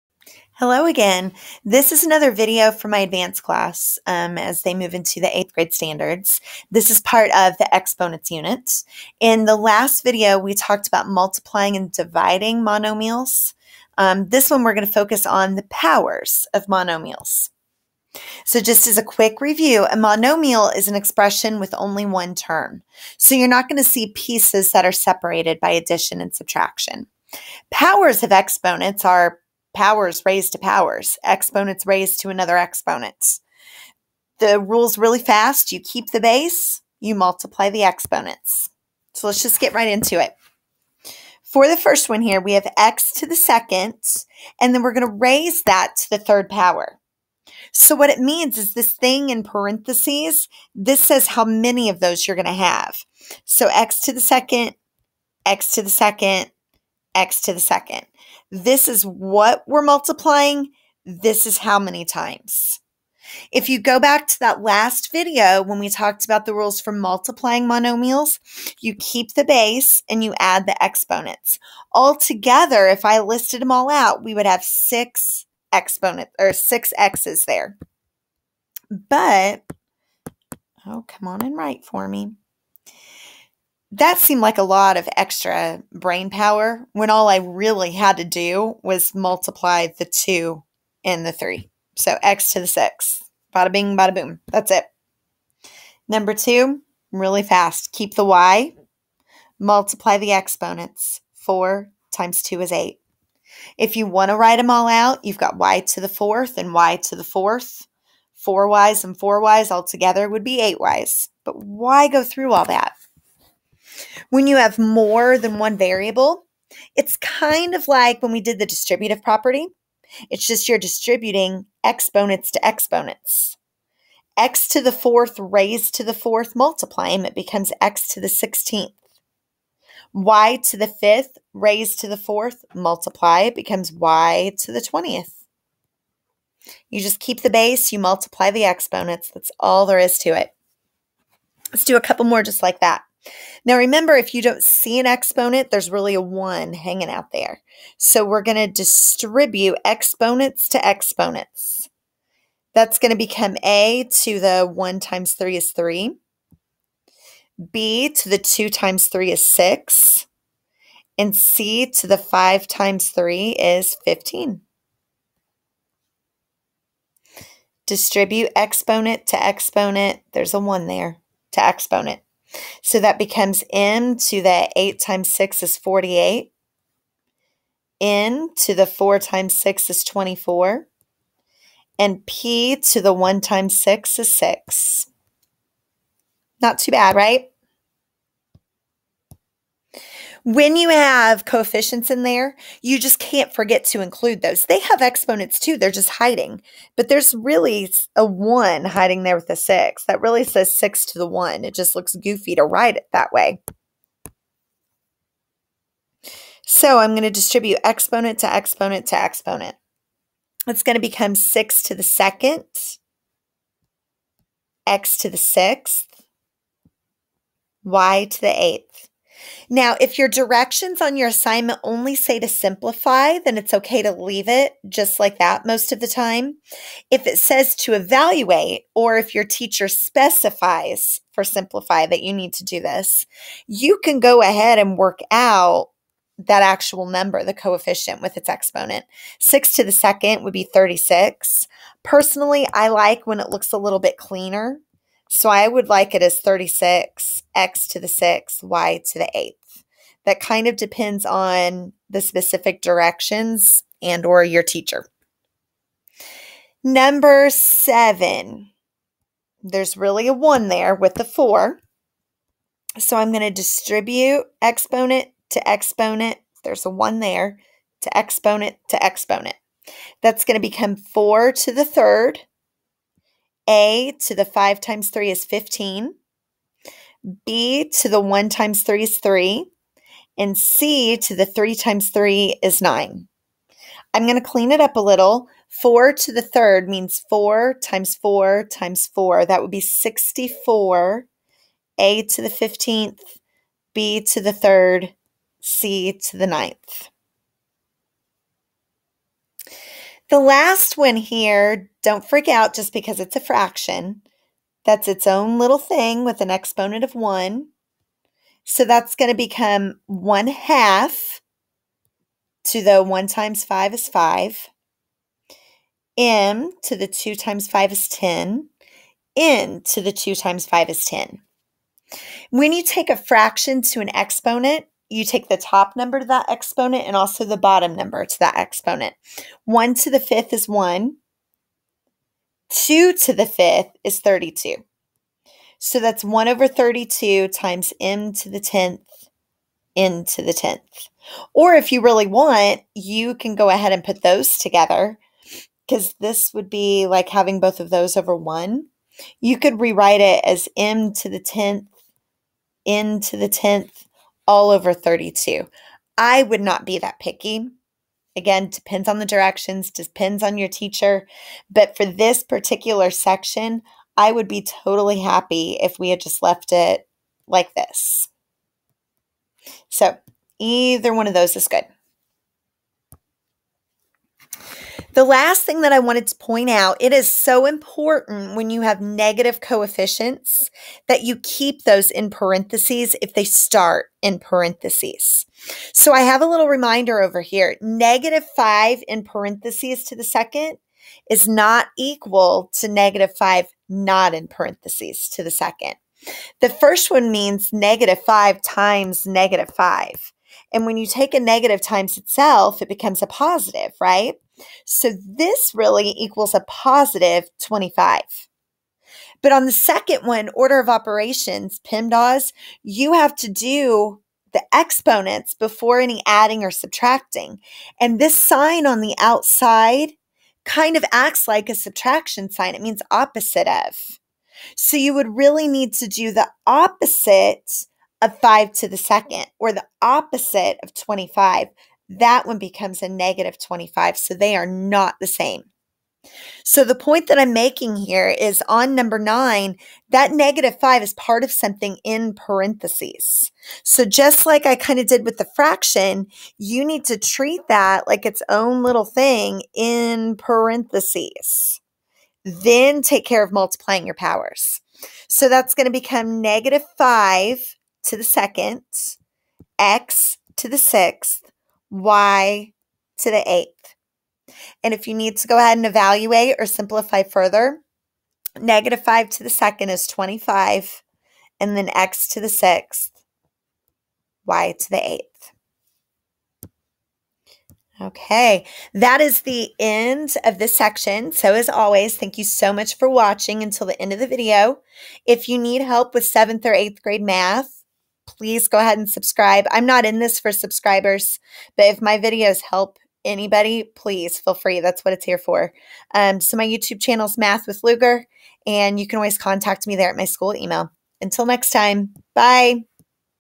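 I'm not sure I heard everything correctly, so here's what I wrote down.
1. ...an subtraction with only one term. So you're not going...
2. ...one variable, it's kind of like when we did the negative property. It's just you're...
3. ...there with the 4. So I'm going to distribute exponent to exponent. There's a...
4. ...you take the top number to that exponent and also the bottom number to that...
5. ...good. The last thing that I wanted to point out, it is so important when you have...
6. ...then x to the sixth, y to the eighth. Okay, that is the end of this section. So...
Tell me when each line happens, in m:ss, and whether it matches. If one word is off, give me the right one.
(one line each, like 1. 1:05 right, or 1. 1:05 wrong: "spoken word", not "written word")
1. 0:20 wrong: "expression", not "subtraction"
2. 1:55 wrong: "distributive", not "negative"
3. 4:20 right
4. 5:25 right
5. 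6:11 right
6. 7:51 right.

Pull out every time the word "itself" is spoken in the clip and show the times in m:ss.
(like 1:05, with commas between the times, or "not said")
6:42.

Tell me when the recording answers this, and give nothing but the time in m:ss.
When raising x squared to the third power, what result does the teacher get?
1:32.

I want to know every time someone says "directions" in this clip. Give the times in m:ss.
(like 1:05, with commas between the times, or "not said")
3:40, 4:12, 5:59.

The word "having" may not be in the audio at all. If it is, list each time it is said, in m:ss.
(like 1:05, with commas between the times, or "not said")
5:47.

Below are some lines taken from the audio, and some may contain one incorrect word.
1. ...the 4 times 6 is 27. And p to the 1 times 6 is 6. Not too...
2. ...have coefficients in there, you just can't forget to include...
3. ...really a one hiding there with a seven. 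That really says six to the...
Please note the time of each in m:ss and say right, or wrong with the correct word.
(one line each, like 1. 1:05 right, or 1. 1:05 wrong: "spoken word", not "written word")
1. 2:58 wrong: "24", not "27"
2. 3:10 right
3. 3:17 wrong: "six", not "seven".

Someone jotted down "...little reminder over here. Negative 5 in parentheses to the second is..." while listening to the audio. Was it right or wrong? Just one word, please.
right.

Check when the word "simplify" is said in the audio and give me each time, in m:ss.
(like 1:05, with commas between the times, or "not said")
3:42, 3:51, 7:46.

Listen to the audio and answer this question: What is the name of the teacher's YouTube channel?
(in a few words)
Math with Lugar.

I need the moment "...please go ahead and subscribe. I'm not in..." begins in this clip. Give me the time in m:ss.
8:08.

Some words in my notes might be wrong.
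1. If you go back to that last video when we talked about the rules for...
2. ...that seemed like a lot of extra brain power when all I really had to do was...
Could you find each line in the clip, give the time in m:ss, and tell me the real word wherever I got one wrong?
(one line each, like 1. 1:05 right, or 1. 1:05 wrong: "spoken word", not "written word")
1. 1:03 right
2. 1:23 right.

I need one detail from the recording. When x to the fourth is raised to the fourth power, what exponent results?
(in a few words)
16.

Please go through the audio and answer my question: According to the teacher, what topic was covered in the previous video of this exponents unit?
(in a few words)
Multiplying and dividing monomials.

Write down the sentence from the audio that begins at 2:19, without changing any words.
That's all there is to it.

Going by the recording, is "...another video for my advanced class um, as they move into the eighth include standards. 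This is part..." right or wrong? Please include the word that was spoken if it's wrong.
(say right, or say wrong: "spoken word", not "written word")
wrong: "grade", not "include".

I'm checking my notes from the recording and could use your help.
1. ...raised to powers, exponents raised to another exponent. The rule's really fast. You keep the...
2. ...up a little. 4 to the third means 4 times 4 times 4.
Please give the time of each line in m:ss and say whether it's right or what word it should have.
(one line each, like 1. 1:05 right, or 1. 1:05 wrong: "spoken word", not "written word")
1. 0:30 right
2. 4:44 right.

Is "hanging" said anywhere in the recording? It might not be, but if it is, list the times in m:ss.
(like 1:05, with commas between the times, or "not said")
2:26.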